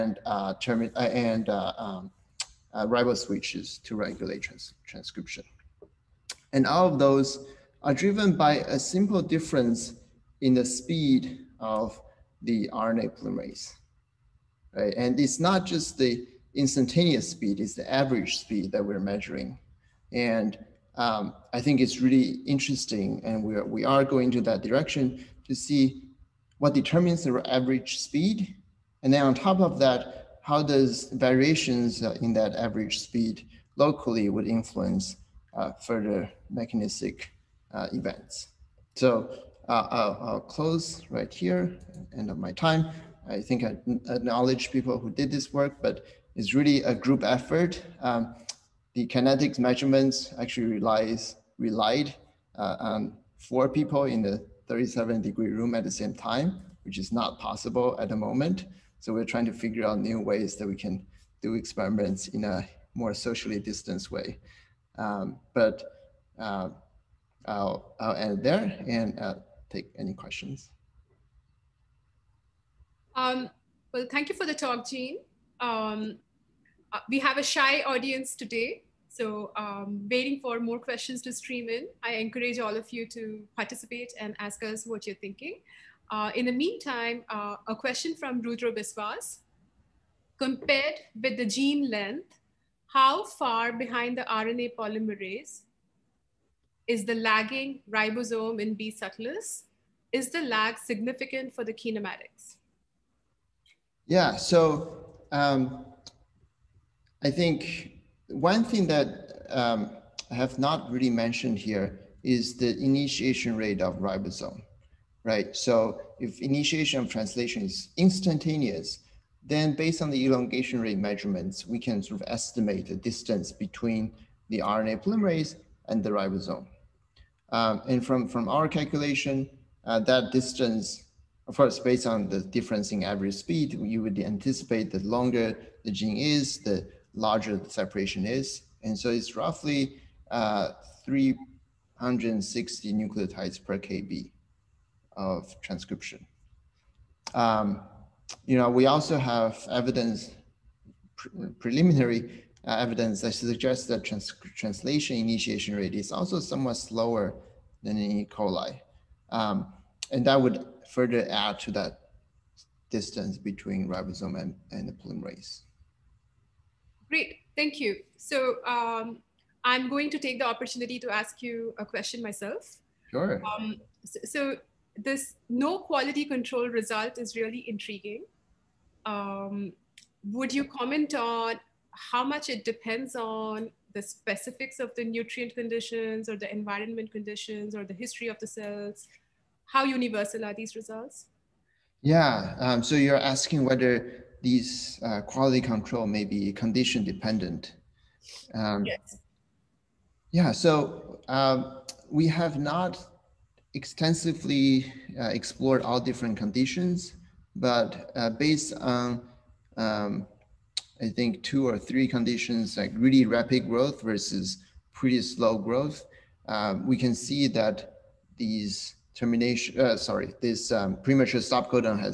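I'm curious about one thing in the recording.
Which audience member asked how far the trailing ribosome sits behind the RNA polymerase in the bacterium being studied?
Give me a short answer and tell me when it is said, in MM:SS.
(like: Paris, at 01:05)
Rudra Biswas, at 01:28.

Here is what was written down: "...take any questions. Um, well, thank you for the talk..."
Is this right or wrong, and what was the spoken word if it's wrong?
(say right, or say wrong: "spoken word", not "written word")
right.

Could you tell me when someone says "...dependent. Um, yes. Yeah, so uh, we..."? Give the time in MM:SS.
03:17.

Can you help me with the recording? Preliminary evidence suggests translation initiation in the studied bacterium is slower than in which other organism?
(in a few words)
E. coli.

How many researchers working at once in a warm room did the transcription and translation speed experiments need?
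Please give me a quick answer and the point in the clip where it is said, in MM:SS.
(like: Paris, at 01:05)
4, at 00:53.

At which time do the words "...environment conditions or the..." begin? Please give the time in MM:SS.
03:06.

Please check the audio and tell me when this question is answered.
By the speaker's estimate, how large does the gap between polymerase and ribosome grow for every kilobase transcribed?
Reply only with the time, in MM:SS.
02:21.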